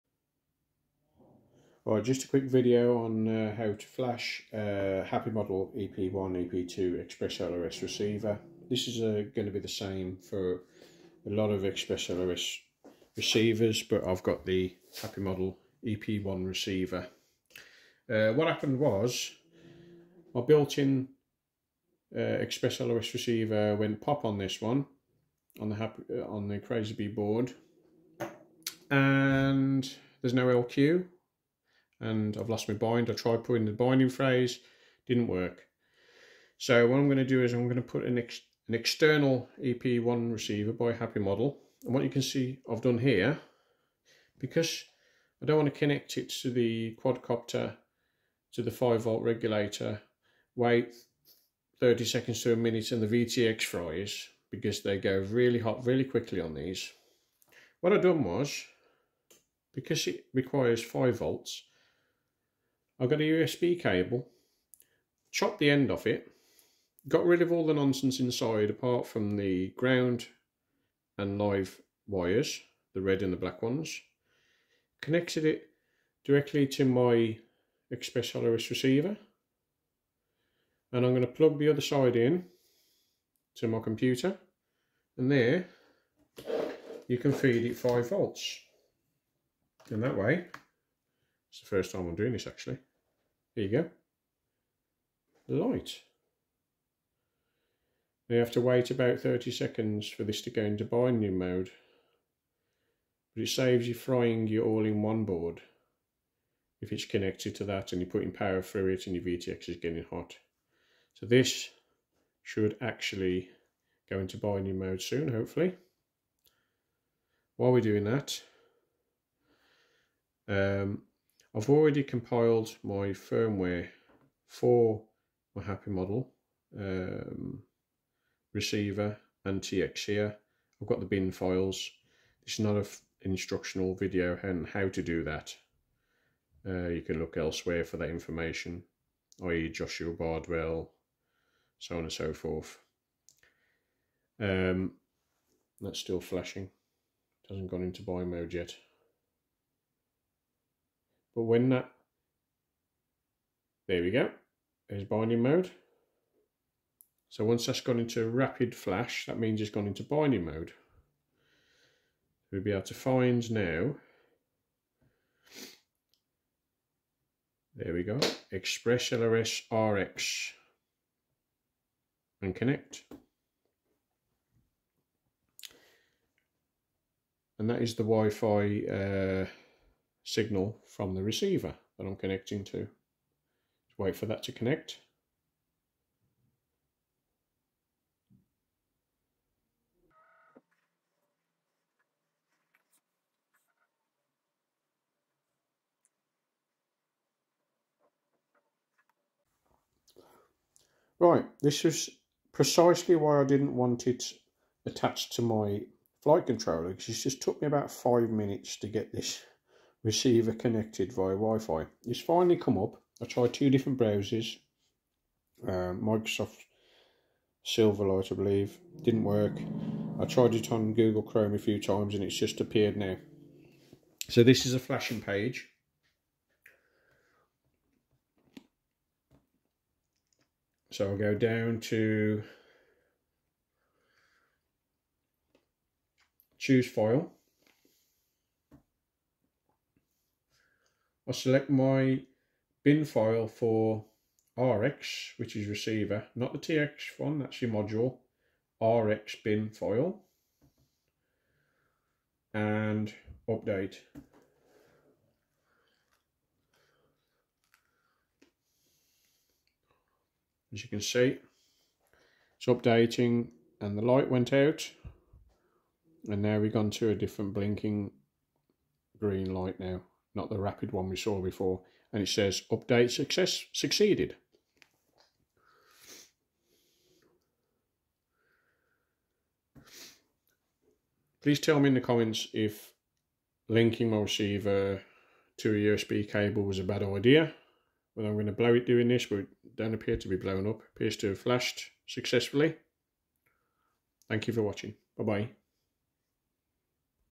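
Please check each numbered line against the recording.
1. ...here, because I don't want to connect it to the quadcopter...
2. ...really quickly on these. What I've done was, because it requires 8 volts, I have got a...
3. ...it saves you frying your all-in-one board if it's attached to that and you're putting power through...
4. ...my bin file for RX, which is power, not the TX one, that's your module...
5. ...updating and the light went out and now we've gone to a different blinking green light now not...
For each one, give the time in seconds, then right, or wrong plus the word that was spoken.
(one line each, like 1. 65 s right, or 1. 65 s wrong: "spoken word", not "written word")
1. 42 s right
2. 55 s wrong: "5", not "8"
3. 103 s wrong: "connected", not "attached"
4. 241 s wrong: "receiver", not "power"
5. 262 s right.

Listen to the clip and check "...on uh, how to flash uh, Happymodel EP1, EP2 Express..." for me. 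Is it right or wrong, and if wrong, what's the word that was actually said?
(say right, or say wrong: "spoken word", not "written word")
right.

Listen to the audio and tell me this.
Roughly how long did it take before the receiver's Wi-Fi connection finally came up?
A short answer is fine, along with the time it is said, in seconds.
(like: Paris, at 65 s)
5 minutes, at 207 s.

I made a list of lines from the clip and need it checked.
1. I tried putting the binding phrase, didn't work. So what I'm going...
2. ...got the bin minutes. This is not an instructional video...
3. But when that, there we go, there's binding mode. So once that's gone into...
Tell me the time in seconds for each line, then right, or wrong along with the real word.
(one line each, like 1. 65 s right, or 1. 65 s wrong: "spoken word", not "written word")
1. 33 s right
2. 130 s wrong: "files", not "minutes"
3. 151 s right.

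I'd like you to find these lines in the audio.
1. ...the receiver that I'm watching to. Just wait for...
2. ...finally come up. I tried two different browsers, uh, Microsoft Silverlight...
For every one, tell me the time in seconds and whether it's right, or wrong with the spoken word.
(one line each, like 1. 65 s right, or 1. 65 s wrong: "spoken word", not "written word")
1. 181 s wrong: "connecting", not "watching"
2. 212 s right.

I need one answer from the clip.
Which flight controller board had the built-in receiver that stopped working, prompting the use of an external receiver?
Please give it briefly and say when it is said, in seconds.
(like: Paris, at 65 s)
Crazy Bee, at 26 s.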